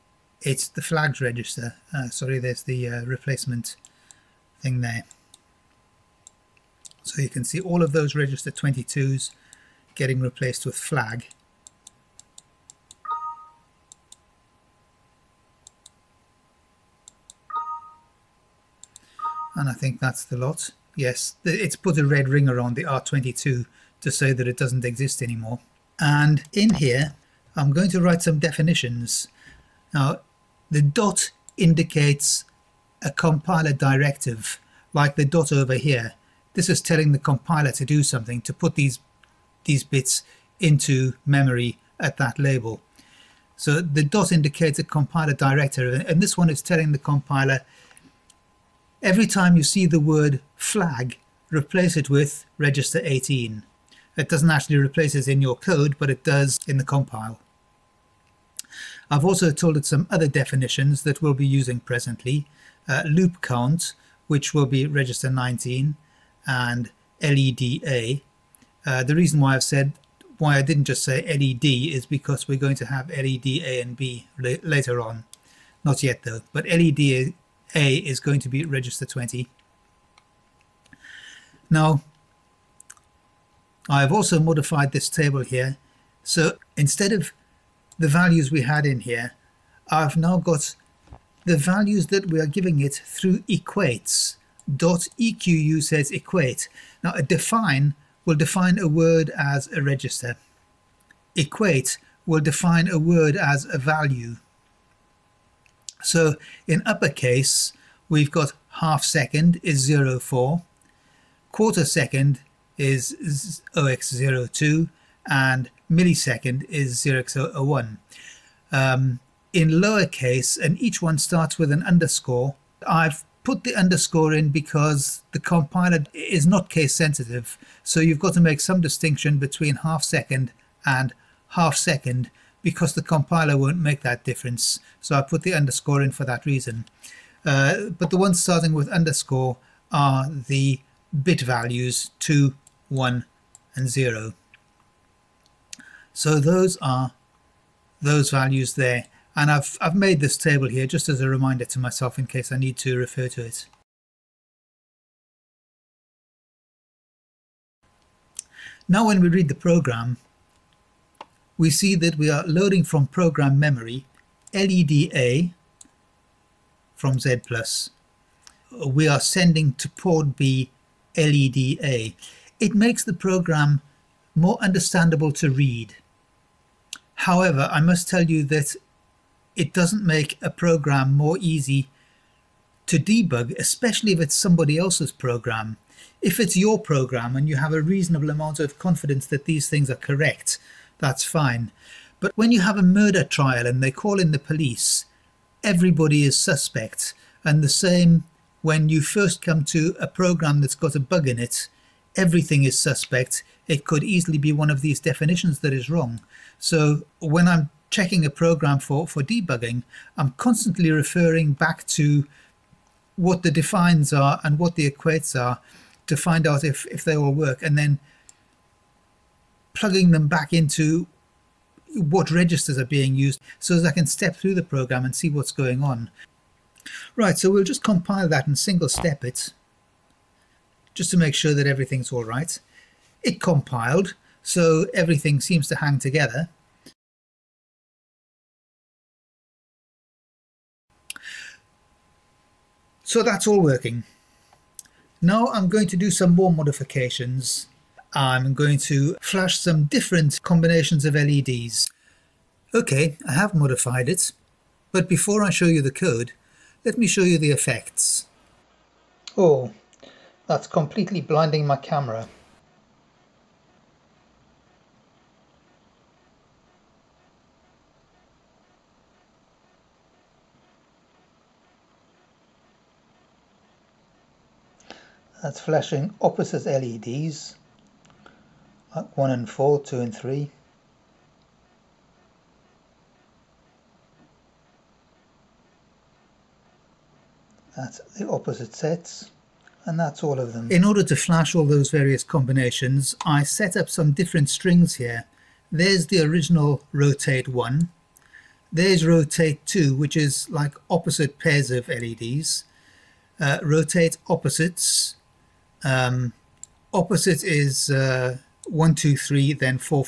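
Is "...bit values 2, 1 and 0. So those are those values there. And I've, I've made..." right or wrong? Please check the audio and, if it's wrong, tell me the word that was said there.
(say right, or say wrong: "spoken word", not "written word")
right.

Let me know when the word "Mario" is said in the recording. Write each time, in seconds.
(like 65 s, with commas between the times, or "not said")
not said.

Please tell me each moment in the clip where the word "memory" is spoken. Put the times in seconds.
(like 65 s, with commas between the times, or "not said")
41 s, 163 s.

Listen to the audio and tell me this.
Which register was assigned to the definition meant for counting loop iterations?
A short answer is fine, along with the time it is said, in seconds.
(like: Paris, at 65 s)
register 19, at 64 s.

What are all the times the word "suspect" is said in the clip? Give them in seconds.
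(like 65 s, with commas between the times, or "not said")
196 s, 202 s.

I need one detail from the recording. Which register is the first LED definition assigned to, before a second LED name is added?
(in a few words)
register 20.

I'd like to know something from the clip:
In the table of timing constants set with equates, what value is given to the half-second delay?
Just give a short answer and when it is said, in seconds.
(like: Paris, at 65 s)
04, at 110 s.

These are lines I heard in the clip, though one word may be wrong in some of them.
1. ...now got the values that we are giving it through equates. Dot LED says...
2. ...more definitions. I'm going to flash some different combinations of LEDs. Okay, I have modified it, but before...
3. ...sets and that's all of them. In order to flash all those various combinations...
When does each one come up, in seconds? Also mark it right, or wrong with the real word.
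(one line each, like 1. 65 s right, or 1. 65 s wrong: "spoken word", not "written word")
1. 90 s wrong: "EQU", not "LED"
2. 246 s wrong: "modifications", not "definitions"
3. 288 s right.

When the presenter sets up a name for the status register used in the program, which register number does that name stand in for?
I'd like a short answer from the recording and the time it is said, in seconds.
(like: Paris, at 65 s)
18, at 52 s.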